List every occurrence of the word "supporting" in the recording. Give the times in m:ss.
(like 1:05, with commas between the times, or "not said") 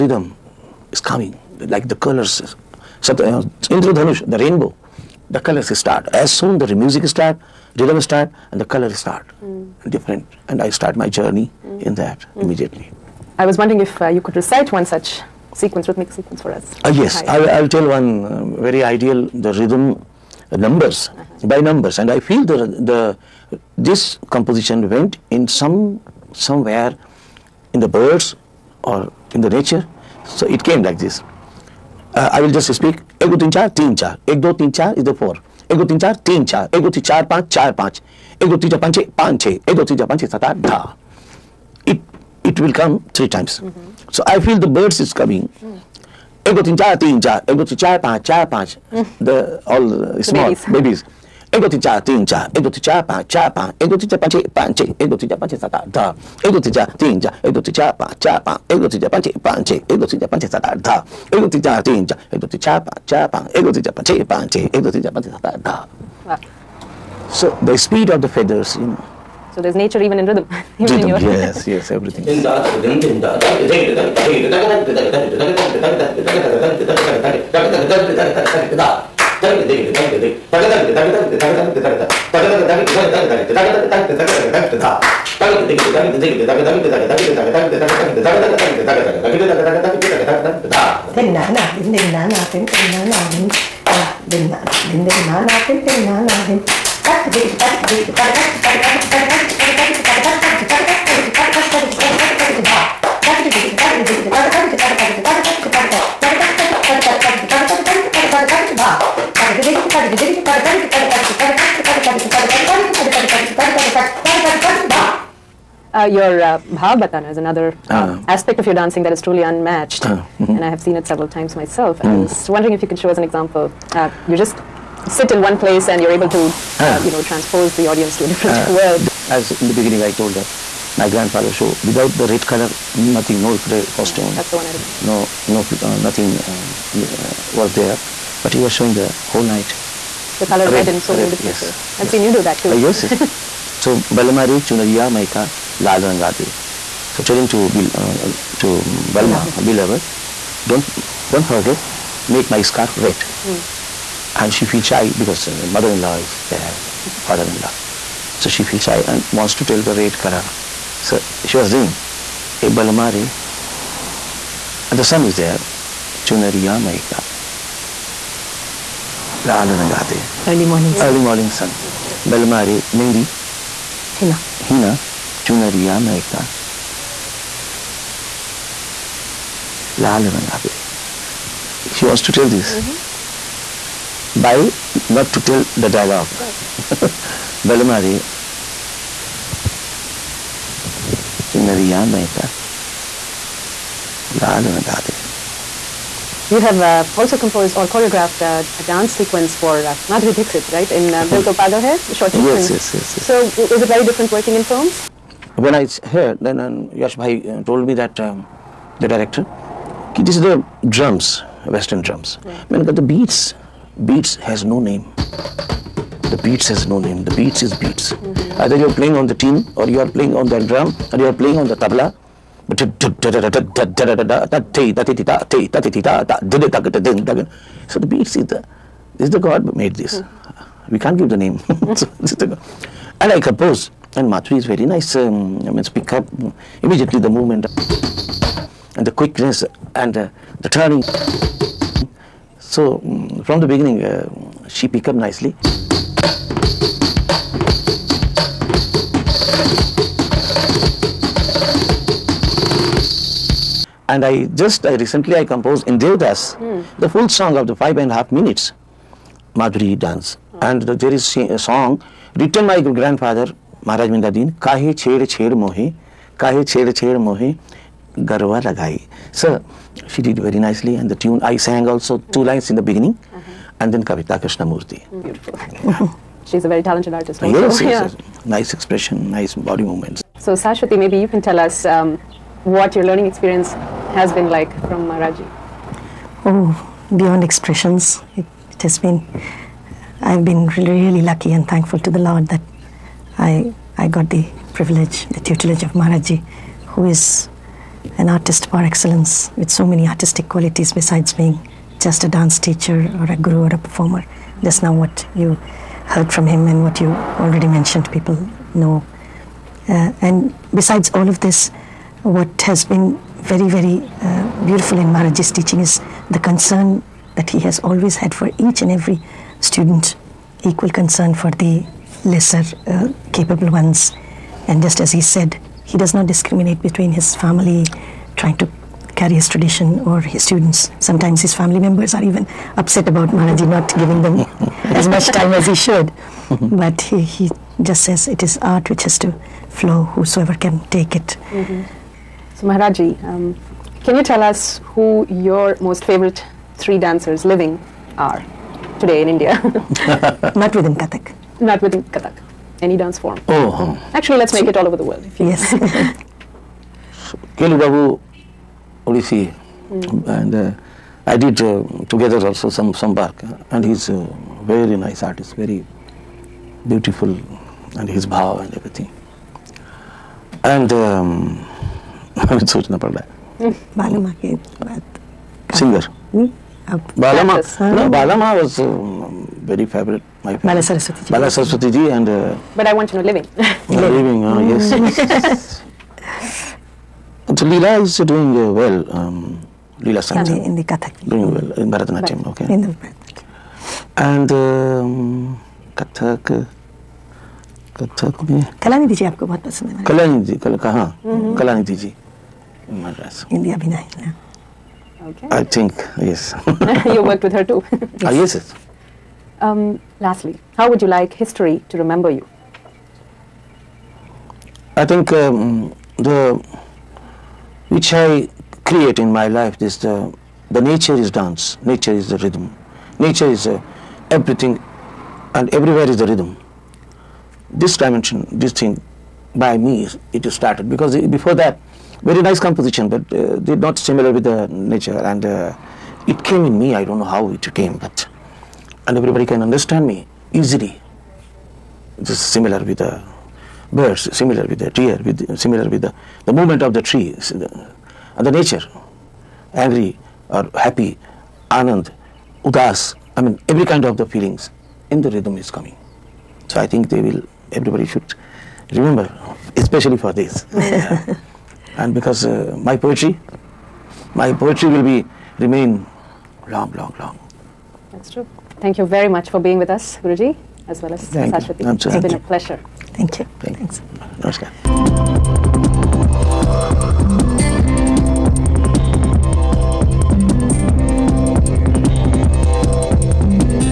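not said.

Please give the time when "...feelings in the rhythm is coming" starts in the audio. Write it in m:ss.
7:34.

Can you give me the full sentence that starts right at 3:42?
But so the beats is the this is the God made this.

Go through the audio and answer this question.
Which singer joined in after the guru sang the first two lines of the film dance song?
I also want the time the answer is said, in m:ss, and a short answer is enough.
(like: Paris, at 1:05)
Kavita Murthy, at 4:34.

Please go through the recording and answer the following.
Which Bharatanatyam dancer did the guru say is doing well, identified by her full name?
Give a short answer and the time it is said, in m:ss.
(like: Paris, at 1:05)
Leela Samson, at 6:30.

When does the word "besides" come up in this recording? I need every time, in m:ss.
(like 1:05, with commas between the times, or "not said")
5:00, 5:10.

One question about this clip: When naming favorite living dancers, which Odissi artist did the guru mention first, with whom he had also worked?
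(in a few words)
Kelu Babu.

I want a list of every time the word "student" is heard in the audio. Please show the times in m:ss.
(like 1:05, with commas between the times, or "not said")
5:19, 5:30.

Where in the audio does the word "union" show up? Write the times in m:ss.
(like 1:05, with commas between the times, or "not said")
not said.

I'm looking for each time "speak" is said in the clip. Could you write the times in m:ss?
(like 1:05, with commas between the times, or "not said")
0:32, 3:55.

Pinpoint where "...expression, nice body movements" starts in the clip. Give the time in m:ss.
4:38.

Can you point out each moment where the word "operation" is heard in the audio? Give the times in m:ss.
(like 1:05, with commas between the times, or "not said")
not said.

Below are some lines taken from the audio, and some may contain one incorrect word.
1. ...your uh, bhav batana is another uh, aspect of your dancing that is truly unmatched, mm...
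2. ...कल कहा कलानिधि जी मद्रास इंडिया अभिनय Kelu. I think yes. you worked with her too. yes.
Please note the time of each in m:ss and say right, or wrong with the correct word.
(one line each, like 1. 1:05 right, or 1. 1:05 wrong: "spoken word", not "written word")
1. 1:56 right
2. 6:40 wrong: "Okay", not "Kelu".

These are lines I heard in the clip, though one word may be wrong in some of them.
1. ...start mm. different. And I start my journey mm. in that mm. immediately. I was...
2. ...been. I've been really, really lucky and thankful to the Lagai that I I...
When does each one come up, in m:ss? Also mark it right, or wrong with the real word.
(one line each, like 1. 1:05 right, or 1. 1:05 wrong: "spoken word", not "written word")
1. 0:08 right
2. 4:48 wrong: "Lord", not "Lagai".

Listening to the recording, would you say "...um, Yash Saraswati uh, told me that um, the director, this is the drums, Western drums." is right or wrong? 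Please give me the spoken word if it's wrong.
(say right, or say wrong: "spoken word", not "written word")
wrong: "Bhai", not "Saraswati".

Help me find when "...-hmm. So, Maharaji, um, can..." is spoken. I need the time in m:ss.
5:41.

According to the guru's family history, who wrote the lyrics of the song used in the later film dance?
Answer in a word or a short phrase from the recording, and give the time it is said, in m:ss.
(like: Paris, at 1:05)
Maharaj Bindadin, at 4:23.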